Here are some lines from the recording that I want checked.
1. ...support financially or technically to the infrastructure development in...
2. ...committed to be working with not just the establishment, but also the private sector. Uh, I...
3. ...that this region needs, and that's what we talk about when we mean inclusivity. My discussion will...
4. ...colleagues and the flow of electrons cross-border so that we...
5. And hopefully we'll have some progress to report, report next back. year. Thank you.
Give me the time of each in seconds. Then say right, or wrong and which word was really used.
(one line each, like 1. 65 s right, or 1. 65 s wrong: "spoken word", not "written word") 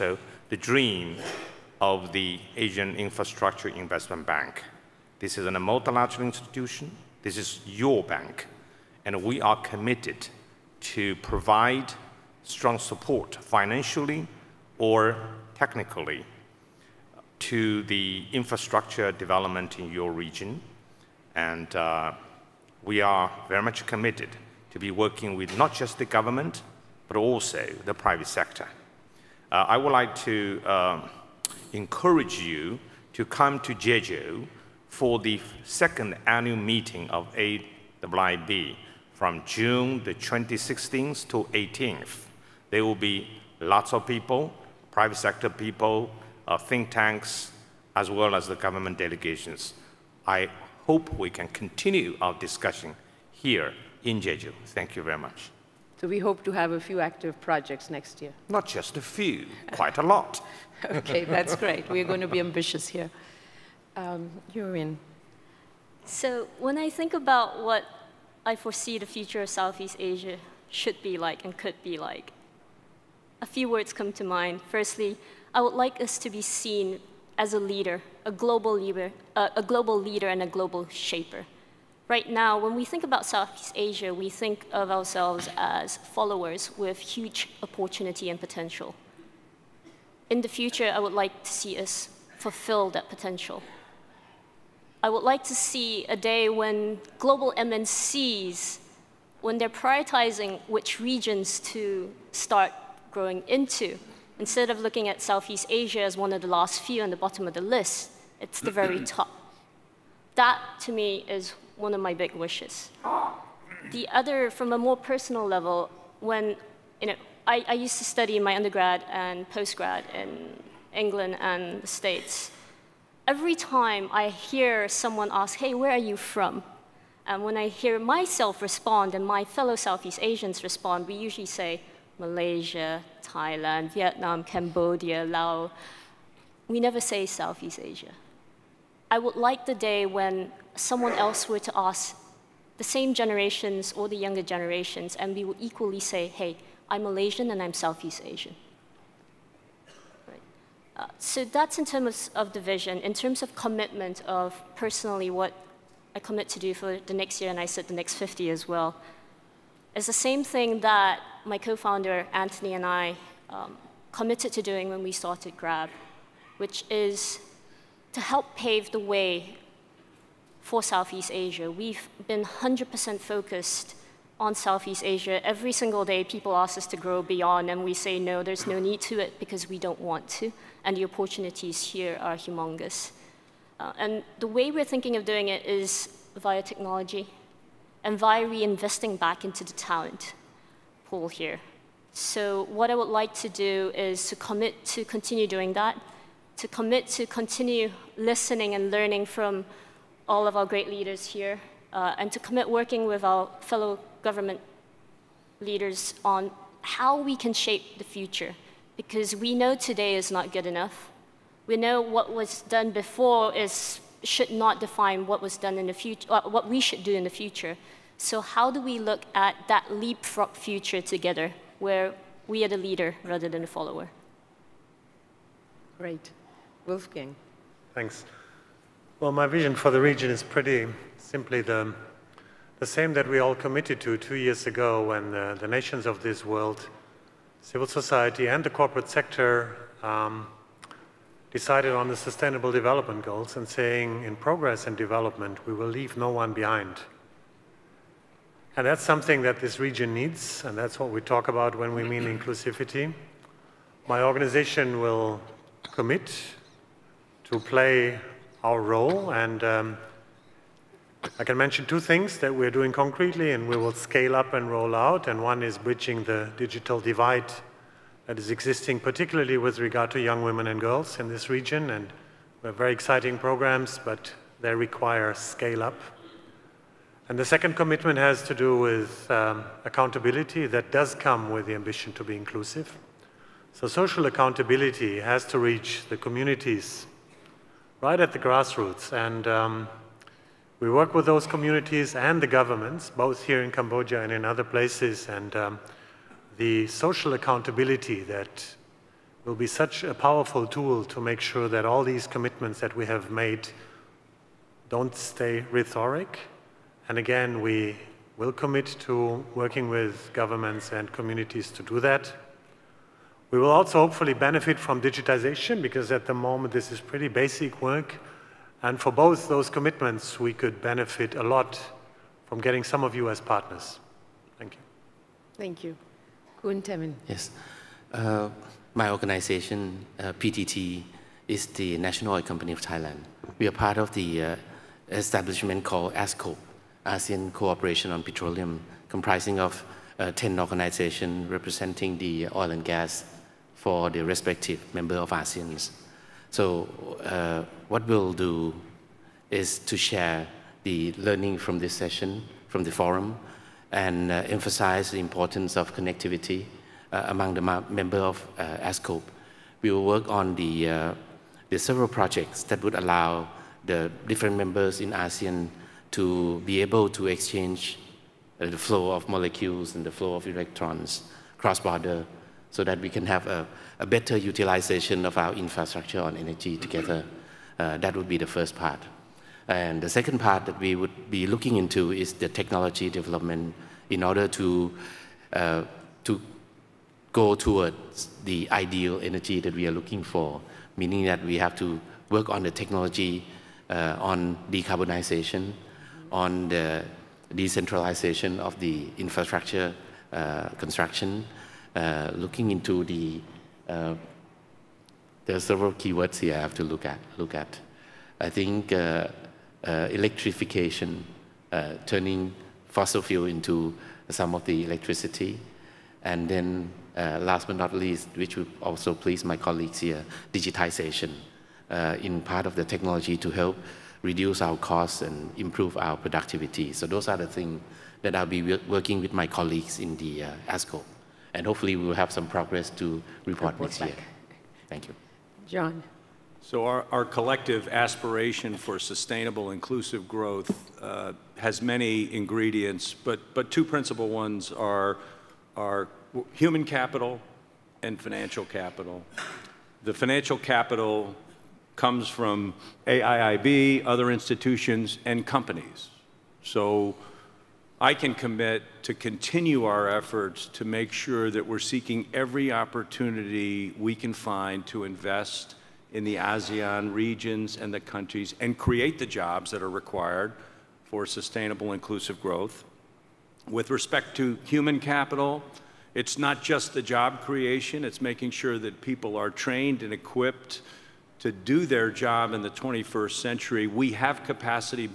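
1. 12 s right
2. 23 s wrong: "government", not "establishment"
3. 249 s wrong: "organization", not "discussion"
4. 369 s wrong: "molecules", not "colleagues"
5. 431 s right.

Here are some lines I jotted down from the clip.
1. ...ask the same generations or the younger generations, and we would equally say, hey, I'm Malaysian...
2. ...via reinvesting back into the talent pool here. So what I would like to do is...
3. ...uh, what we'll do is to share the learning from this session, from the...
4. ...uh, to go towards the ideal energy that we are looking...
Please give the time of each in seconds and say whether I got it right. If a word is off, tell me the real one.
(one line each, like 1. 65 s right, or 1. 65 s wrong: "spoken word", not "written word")
1. 141 s right
2. 188 s right
3. 347 s right
4. 385 s right.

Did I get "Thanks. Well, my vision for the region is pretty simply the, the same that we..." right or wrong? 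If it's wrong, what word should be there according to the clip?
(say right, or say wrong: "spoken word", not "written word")
right.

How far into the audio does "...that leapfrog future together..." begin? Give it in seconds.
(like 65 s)
219 s.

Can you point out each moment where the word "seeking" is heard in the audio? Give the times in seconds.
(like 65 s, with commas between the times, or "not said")
461 s.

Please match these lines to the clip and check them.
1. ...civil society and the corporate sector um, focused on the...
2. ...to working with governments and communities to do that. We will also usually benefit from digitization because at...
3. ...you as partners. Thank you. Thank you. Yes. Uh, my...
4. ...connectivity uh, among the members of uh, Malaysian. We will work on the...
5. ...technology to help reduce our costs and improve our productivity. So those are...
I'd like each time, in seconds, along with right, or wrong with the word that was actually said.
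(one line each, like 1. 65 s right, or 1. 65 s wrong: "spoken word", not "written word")
1. 237 s wrong: "decided", not "focused"
2. 309 s wrong: "hopefully", not "usually"
3. 323 s right
4. 355 s wrong: "ASCOPE", not "Malaysian"
5. 422 s right.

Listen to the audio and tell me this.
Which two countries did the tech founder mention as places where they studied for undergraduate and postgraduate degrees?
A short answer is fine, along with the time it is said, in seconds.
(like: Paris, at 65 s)
England and the States, at 120 s.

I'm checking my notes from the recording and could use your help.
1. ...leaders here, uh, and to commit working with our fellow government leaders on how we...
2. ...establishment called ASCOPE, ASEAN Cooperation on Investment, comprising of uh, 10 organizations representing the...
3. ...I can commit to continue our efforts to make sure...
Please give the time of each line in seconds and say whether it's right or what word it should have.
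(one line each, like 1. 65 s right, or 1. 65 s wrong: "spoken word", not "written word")
1. 200 s right
2. 335 s wrong: "Petroleum", not "Investment"
3. 457 s right.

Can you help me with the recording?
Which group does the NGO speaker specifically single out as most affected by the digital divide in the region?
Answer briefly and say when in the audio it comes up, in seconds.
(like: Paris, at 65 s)
young women and girls, at 270 s.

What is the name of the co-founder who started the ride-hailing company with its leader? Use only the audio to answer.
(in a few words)
Anthony.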